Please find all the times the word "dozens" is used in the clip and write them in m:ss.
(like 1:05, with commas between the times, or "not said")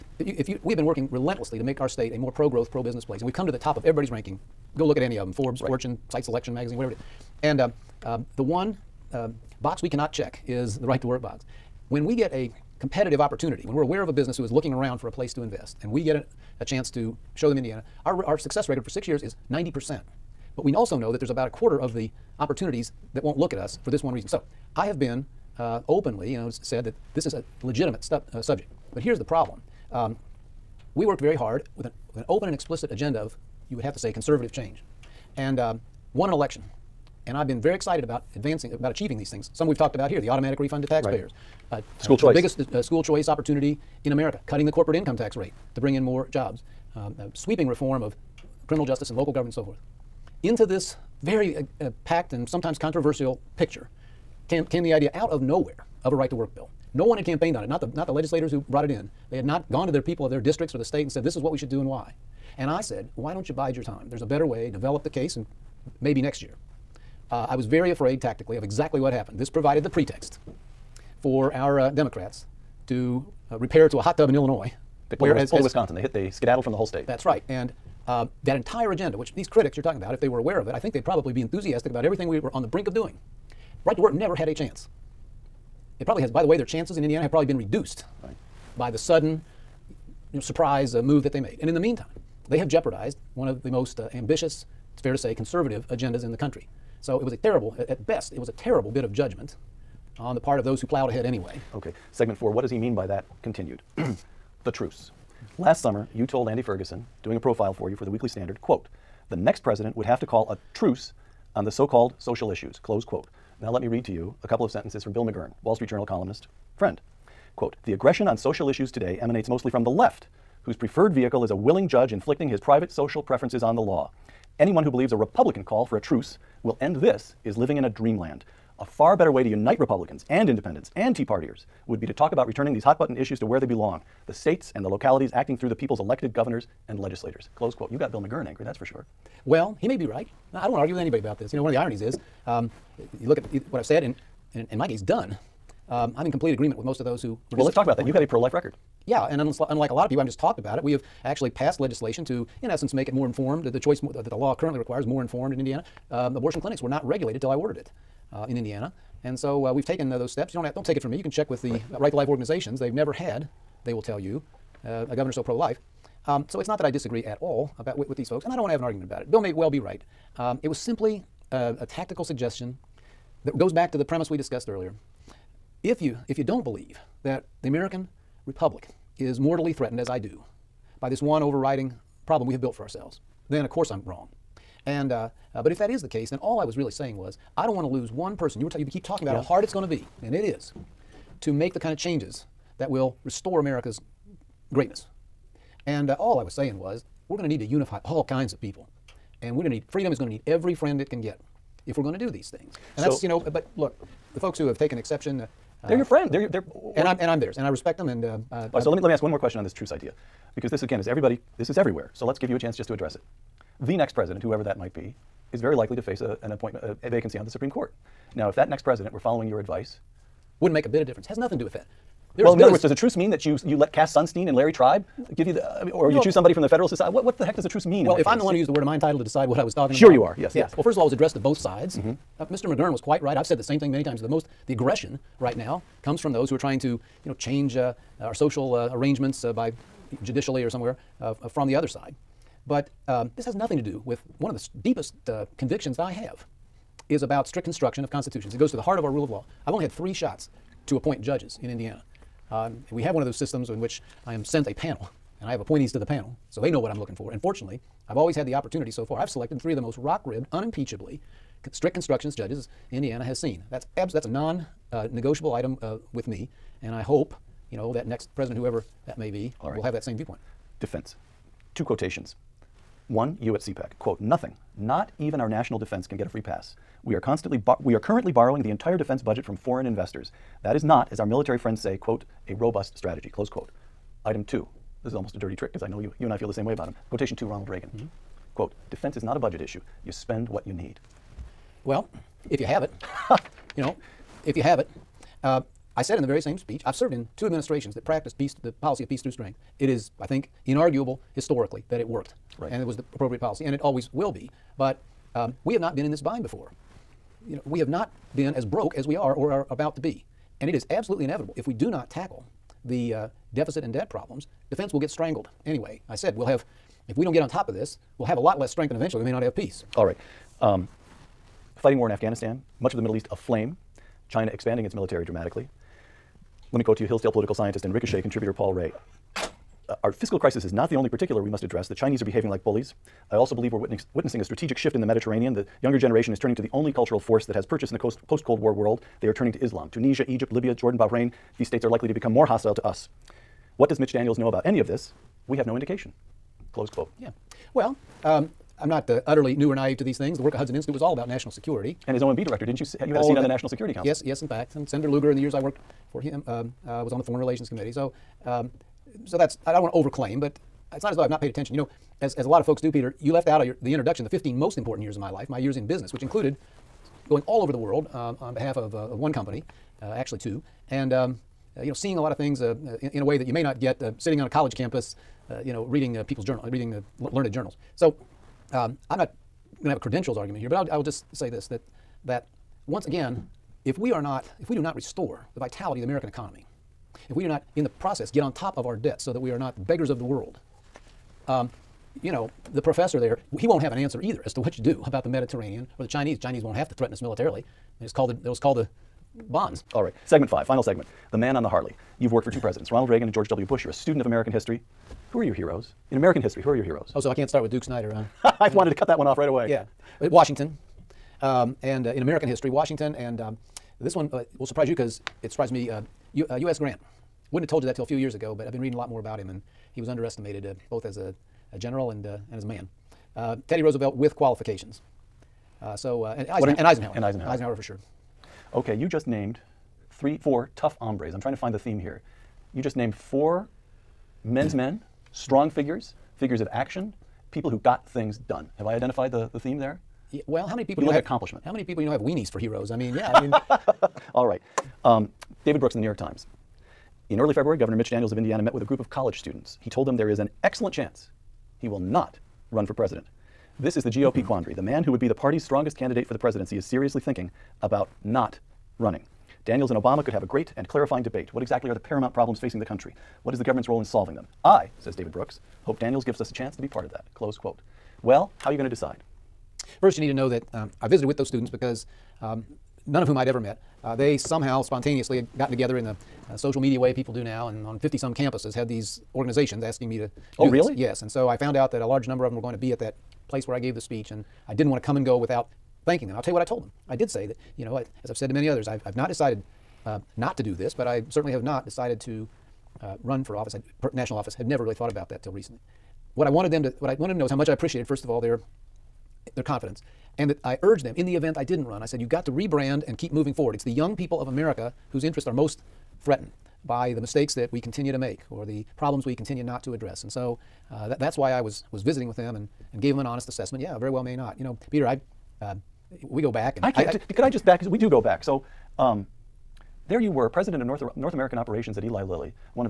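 not said.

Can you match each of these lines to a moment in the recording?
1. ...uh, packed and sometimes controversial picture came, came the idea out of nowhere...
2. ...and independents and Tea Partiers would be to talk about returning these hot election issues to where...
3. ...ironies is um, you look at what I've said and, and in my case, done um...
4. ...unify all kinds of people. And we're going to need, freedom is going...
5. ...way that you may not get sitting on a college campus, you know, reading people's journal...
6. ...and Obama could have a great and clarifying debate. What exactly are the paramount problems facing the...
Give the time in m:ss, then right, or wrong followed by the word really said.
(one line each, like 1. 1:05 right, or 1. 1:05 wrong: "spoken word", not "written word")
1. 0:51 right
2. 2:10 wrong: "button", not "election"
3. 2:21 right
4. 3:17 right
5. 6:13 right
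6. 7:39 right.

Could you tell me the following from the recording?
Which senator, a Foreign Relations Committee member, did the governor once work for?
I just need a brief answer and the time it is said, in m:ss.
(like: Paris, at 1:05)
Senator Lugar, at 5:54.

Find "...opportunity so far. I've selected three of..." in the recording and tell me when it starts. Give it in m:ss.
4:18.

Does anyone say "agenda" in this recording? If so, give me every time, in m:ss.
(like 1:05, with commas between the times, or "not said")
0:32, 1:18, 1:35.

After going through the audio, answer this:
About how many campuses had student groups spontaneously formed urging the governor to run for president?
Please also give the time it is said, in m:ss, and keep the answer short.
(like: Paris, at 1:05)
50 some, at 7:57.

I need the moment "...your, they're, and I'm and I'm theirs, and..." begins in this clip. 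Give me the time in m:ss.
3:26.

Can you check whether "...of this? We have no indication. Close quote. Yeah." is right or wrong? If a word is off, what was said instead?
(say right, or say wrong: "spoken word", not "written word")
right.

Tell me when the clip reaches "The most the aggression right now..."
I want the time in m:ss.
3:54.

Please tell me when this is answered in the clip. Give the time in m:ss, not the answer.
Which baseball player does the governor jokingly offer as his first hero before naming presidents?
6:47.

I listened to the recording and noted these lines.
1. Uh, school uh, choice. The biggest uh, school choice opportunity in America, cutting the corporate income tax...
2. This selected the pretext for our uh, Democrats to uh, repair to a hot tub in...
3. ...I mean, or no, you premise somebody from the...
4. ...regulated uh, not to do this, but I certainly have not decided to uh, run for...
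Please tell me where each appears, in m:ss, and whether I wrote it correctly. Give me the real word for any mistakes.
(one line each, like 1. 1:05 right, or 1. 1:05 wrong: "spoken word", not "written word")
1. 0:42 right
2. 1:09 wrong: "provided", not "selected"
3. 3:45 wrong: "choose", not "premise"
4. 8:09 wrong: "decided", not "regulated".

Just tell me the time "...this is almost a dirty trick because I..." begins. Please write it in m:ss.
4:45.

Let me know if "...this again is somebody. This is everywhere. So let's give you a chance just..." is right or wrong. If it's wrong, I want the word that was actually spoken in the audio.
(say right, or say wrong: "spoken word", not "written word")
wrong: "everybody", not "somebody".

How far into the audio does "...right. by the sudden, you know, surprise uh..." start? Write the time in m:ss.
1:28.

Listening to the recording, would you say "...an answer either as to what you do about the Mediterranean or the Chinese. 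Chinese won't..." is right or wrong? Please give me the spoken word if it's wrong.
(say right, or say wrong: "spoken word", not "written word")
right.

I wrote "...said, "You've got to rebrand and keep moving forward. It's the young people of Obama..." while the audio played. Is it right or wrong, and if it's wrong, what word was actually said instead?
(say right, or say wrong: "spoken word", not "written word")
wrong: "America", not "Obama".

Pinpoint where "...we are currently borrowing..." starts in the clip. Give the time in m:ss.
4:37.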